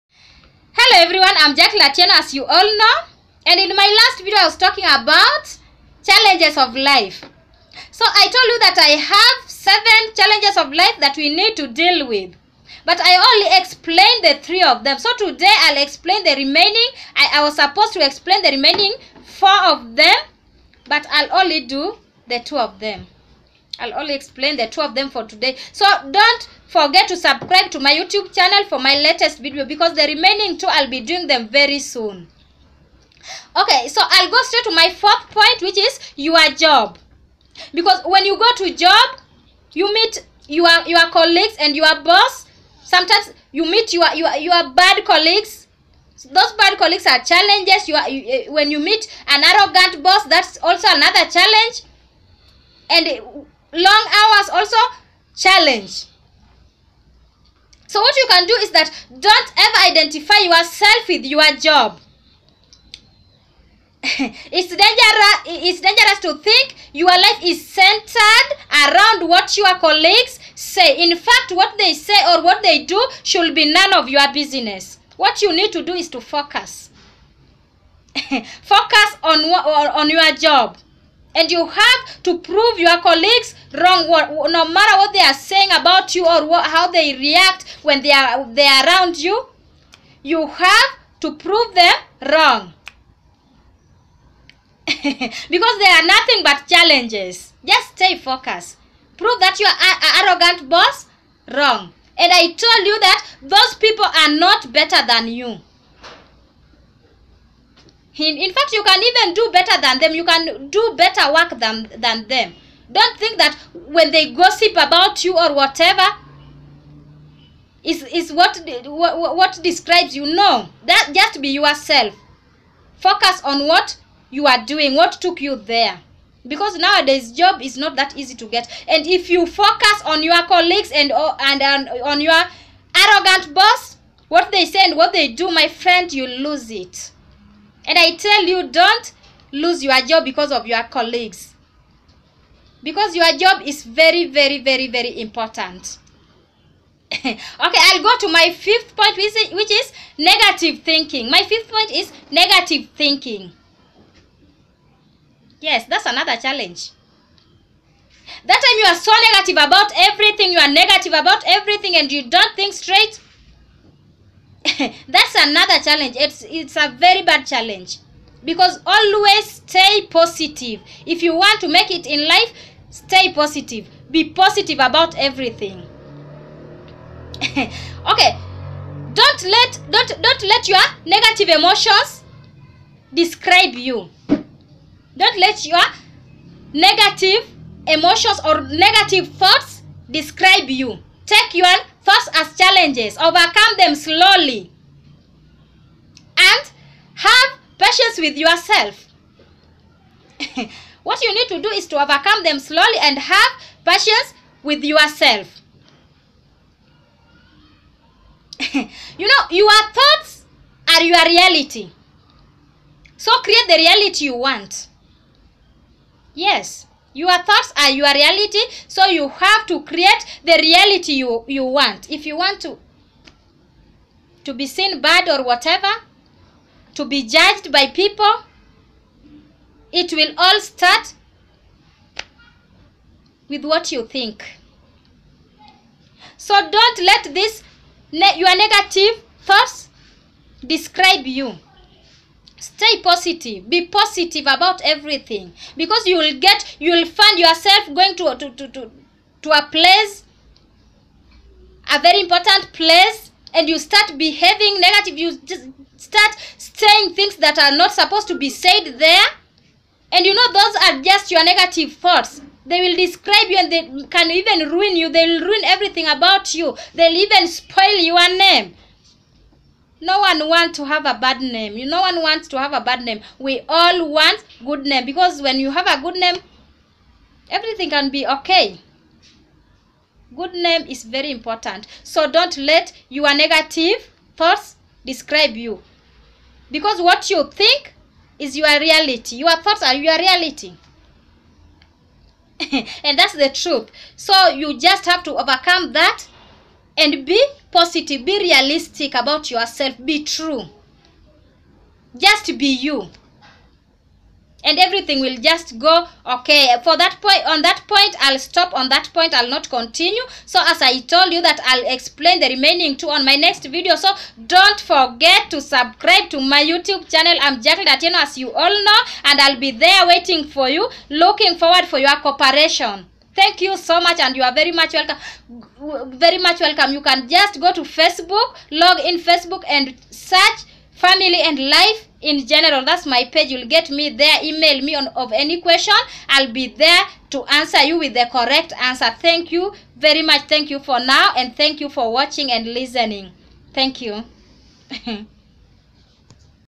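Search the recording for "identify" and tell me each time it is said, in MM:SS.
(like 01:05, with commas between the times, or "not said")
00:59.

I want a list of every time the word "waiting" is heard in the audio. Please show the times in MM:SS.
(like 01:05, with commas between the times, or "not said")
05:20.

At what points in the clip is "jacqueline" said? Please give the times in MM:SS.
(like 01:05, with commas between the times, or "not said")
00:01, 05:17.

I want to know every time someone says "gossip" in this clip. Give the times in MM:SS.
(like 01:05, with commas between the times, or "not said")
01:54.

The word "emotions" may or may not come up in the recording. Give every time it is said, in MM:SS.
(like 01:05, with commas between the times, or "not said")
03:01, 03:07.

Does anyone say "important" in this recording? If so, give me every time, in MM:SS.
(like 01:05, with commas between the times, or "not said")
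02:25, 04:12, 04:41.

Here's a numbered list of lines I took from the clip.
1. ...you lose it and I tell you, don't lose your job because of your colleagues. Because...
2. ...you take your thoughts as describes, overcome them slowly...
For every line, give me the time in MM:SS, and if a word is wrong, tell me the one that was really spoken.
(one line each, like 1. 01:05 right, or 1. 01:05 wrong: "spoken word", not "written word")
1. 02:16 right
2. 03:10 wrong: "challenges", not "describes".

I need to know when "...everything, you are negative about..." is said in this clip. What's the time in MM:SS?
02:39.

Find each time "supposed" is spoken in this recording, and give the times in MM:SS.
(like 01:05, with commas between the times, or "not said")
00:17, 04:17.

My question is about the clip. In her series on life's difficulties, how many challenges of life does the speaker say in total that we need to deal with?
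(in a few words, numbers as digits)
7.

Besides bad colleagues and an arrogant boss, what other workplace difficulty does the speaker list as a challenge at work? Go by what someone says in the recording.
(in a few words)
long hours.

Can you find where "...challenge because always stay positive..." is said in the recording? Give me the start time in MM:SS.
02:47.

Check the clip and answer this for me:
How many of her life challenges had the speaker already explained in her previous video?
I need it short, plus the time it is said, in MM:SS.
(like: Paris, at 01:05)
3, at 00:14.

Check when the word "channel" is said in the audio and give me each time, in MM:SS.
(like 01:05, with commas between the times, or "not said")
00:28, 05:17.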